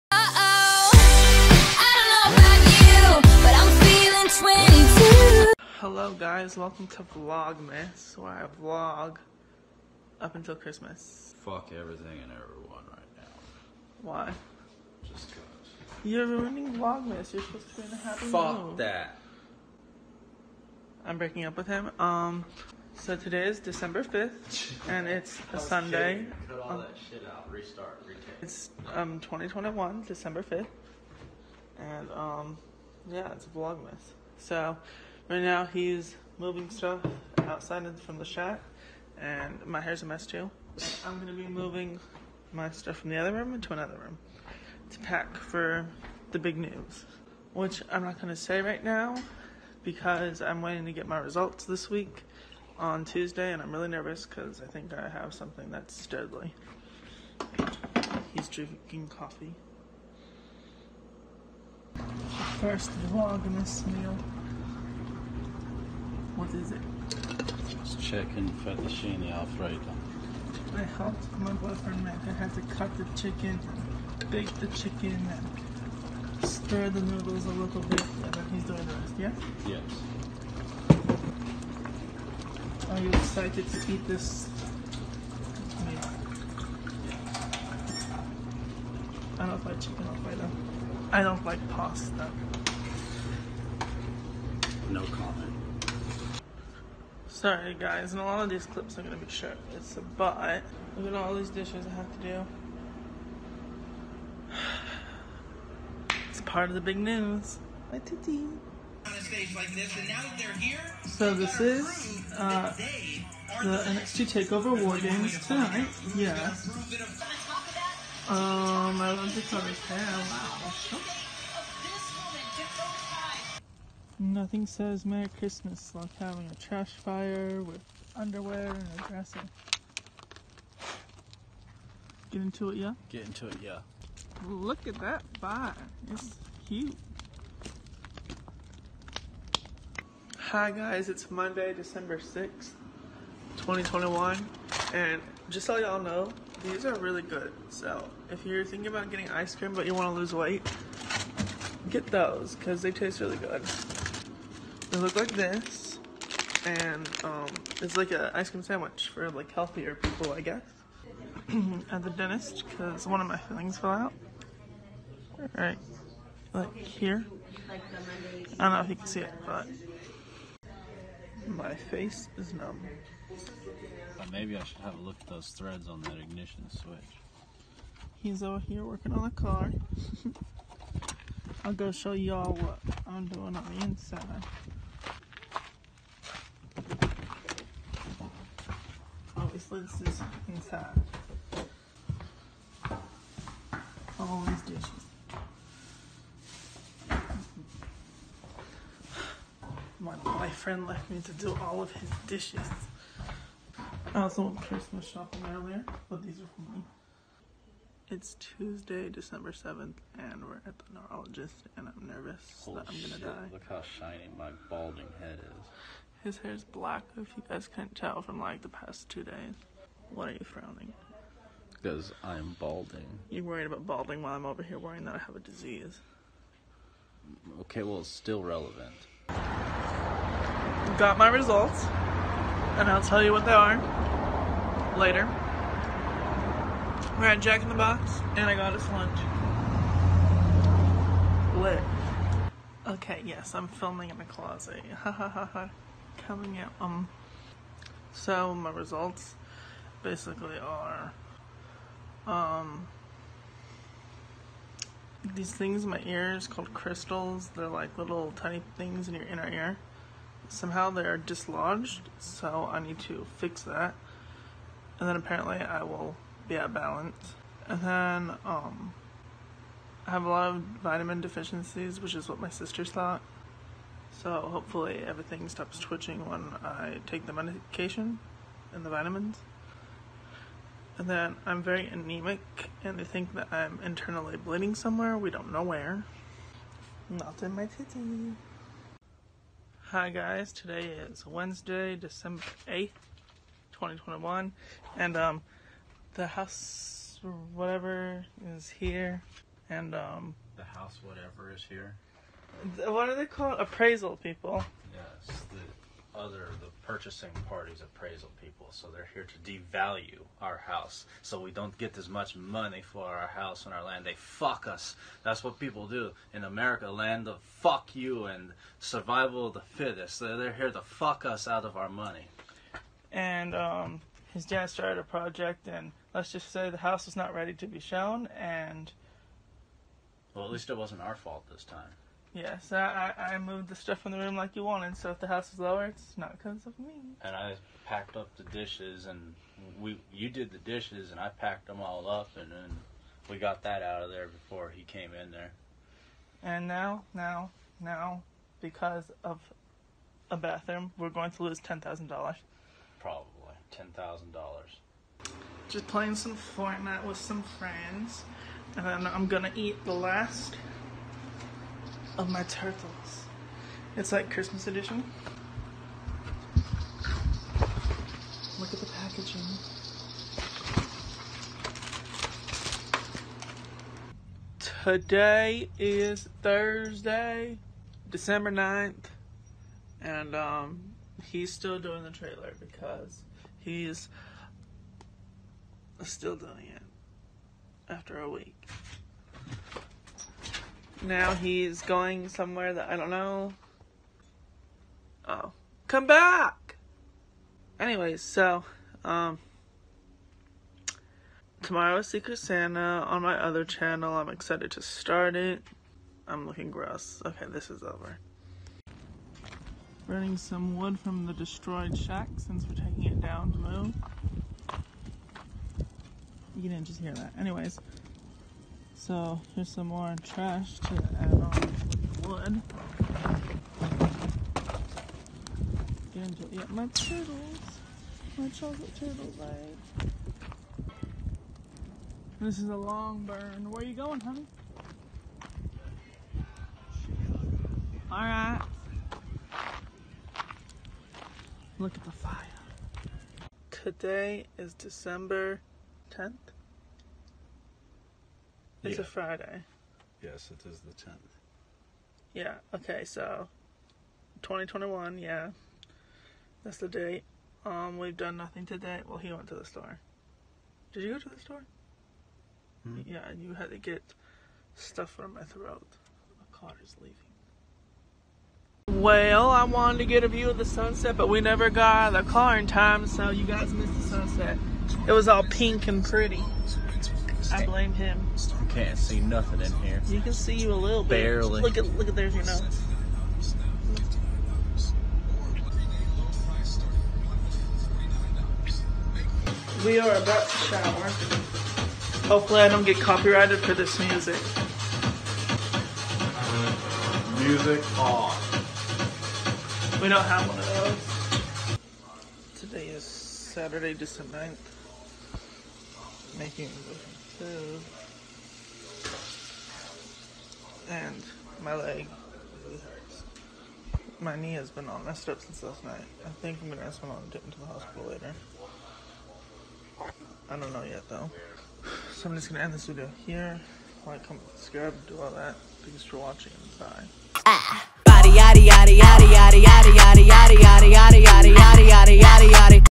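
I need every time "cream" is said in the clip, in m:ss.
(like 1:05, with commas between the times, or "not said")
2:29, 2:38.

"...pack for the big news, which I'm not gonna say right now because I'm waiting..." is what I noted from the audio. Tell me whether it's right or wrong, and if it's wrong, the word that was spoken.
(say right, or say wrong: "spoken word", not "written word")
right.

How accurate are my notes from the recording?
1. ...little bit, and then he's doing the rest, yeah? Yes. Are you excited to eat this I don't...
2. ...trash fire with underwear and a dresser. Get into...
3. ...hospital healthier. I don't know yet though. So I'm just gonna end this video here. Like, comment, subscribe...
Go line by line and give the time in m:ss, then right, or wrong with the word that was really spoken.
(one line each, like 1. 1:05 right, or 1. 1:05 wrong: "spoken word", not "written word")
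1. 1:17 right
2. 2:06 right
3. 8:37 wrong: "later", not "healthier".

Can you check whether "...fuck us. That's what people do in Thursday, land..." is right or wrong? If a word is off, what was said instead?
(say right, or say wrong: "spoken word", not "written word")
wrong: "America", not "Thursday".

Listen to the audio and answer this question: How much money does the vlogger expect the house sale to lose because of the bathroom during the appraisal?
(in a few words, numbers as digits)
$10,000.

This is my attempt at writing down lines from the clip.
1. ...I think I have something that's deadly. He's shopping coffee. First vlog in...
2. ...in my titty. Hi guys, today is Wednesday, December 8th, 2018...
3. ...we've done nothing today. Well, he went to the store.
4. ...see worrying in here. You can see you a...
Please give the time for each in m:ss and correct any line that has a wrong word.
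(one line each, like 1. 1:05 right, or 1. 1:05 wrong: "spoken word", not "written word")
1. 0:54 wrong: "drinking", not "shopping"
2. 4:47 wrong: "2021", not "2018"
3. 7:37 right
4. 7:58 wrong: "nothing", not "worrying".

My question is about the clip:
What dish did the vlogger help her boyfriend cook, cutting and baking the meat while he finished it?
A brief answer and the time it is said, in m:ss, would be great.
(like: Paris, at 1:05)
Chicken fettuccine alfredo, at 1:08.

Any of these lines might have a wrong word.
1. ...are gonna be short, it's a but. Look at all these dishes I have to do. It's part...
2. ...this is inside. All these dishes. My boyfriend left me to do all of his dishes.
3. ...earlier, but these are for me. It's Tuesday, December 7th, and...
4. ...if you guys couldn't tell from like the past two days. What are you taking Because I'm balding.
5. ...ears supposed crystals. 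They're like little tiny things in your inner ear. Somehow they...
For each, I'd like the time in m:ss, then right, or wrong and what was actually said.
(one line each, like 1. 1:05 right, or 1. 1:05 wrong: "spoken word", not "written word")
1. 1:38 right
2. 3:09 right
3. 3:25 right
4. 3:37 wrong: "frowning", not "taking"
5. 4:16 wrong: "called", not "supposed".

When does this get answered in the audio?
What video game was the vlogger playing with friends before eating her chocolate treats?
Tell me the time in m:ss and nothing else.
5:56.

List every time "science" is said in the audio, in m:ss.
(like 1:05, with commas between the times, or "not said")
not said.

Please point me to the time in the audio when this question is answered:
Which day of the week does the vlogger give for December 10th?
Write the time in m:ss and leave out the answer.
7:29.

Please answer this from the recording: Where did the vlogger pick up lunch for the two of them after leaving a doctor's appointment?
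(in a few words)
Jack in the Box.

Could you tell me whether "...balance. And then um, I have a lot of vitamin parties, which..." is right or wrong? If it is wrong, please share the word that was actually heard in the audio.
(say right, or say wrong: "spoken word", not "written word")
wrong: "deficiencies", not "parties".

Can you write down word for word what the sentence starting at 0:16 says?
You're ruining Vlogmas, you're supposed to be in a happy Fuck mood.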